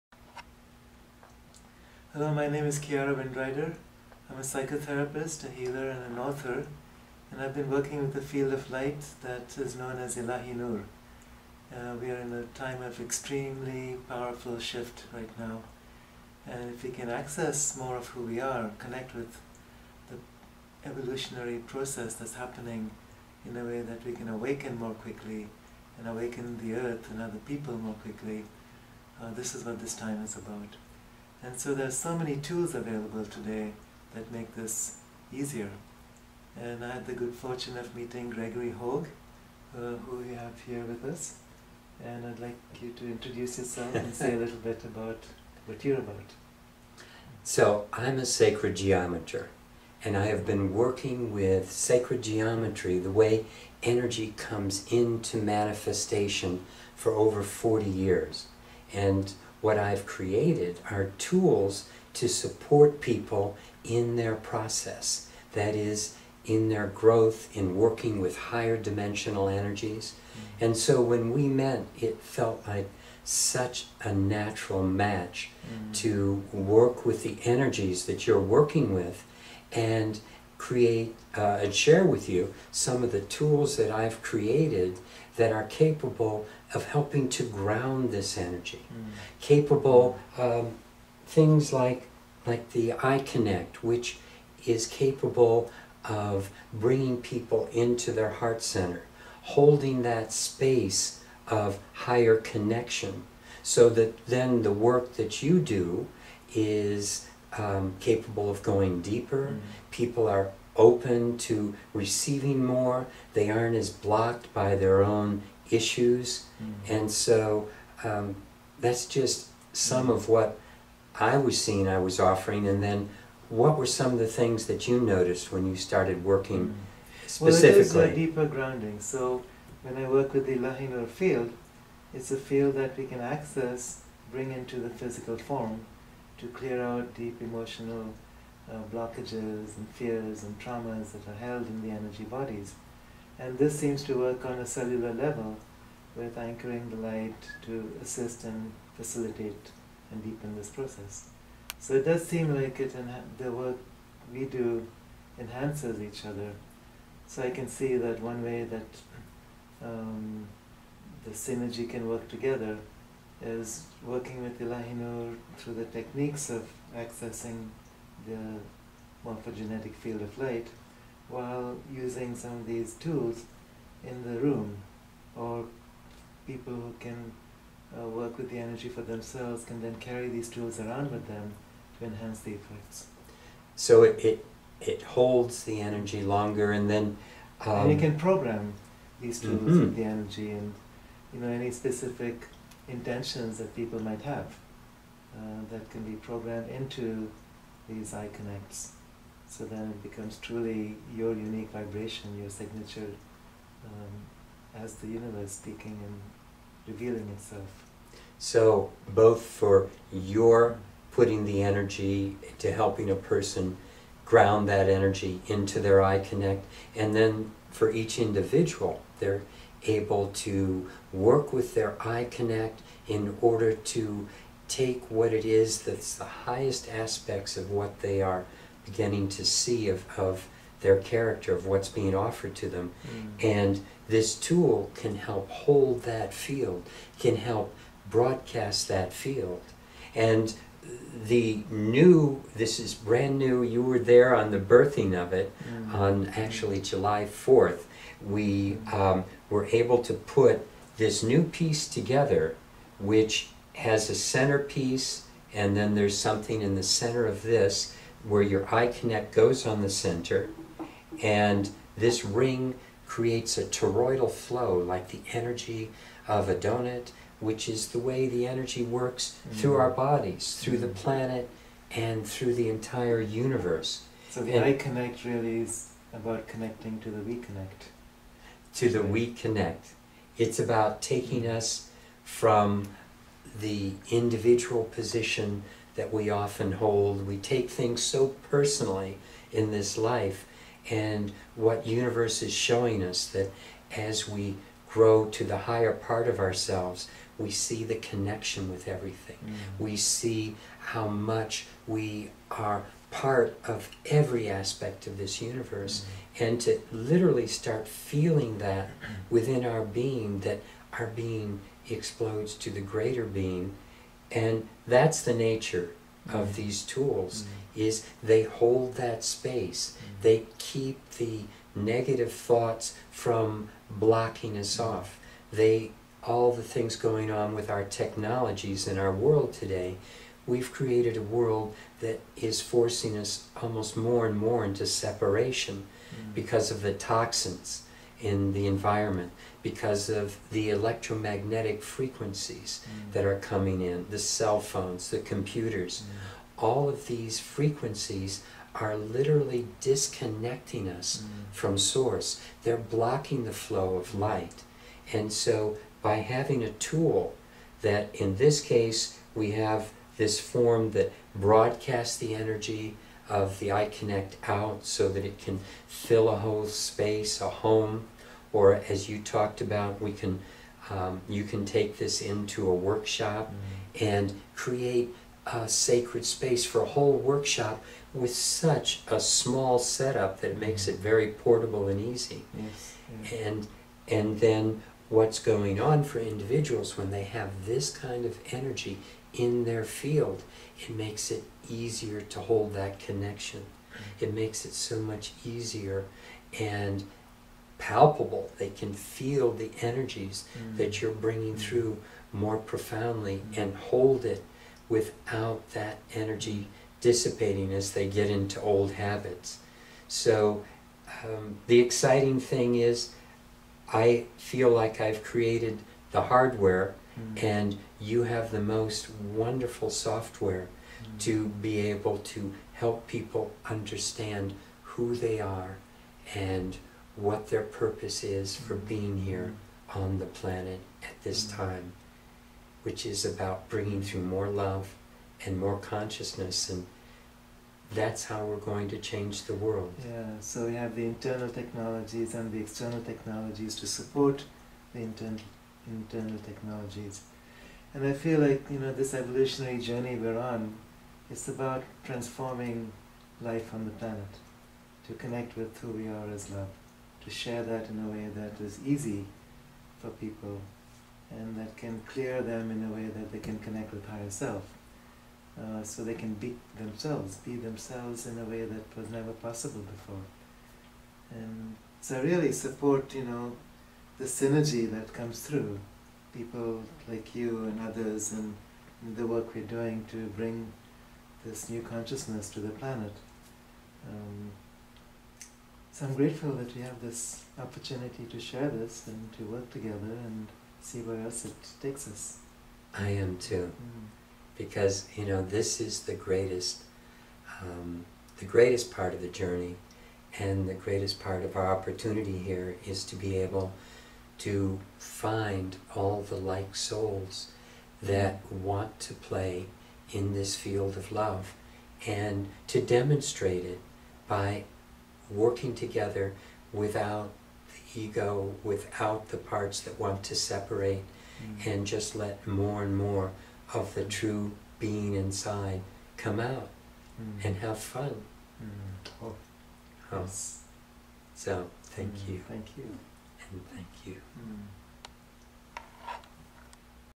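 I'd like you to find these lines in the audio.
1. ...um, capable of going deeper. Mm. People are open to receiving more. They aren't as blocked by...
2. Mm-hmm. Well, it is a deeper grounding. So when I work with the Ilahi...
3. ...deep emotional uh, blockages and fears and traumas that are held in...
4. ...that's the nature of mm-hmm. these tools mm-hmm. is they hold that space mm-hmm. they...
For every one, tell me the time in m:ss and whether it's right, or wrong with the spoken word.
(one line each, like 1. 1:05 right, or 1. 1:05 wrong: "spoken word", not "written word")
1. 1:47 right
2. 2:07 right
3. 2:17 right
4. 5:14 right.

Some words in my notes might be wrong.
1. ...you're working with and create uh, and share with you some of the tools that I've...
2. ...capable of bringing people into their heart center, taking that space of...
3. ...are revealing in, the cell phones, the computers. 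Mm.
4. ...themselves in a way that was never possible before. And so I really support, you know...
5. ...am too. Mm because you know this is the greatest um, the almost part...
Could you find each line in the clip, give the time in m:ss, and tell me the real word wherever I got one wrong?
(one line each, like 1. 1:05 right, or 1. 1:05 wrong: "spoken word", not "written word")
1. 1:18 right
2. 1:34 wrong: "holding", not "taking"
3. 5:43 wrong: "coming", not "revealing"
4. 7:47 right
5. 8:13 wrong: "greatest", not "almost".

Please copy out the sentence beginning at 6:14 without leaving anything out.
and create a sacred space for a whole workshop with such a small setup that makes mm-hmm.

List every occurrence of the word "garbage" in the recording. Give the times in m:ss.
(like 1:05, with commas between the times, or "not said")
not said.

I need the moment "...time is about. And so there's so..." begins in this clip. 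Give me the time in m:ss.
0:29.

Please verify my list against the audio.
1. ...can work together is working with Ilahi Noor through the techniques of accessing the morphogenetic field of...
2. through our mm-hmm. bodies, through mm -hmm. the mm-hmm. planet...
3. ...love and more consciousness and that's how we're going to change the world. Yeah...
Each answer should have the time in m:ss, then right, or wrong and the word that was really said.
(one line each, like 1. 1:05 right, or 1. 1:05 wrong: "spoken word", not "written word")
1. 2:41 right
2. 4:29 right
3. 7:14 right.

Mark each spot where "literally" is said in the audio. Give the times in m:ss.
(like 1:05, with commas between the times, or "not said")
5:06, 5:48.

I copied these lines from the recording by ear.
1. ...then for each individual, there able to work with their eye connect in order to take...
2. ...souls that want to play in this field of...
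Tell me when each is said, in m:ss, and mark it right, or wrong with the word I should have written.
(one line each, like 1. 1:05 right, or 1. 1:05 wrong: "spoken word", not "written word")
1. 3:37 right
2. 8:26 right.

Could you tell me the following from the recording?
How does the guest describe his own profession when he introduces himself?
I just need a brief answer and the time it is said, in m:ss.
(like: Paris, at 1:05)
sacred geometer, at 0:48.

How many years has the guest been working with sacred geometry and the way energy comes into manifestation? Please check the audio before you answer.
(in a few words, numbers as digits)
over 40.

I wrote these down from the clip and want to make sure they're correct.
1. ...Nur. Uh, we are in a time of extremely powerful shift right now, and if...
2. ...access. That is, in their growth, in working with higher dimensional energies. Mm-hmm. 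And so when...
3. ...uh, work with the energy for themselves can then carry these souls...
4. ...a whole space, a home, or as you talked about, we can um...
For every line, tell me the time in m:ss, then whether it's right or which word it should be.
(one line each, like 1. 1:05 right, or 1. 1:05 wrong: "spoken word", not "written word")
1. 0:10 right
2. 1:04 wrong: "process", not "access"
3. 2:57 wrong: "tools", not "souls"
4. 6:06 right.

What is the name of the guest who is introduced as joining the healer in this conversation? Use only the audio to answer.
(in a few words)
Gregory Hogue.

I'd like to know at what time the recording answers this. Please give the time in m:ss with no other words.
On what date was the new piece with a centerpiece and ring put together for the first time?
4:06.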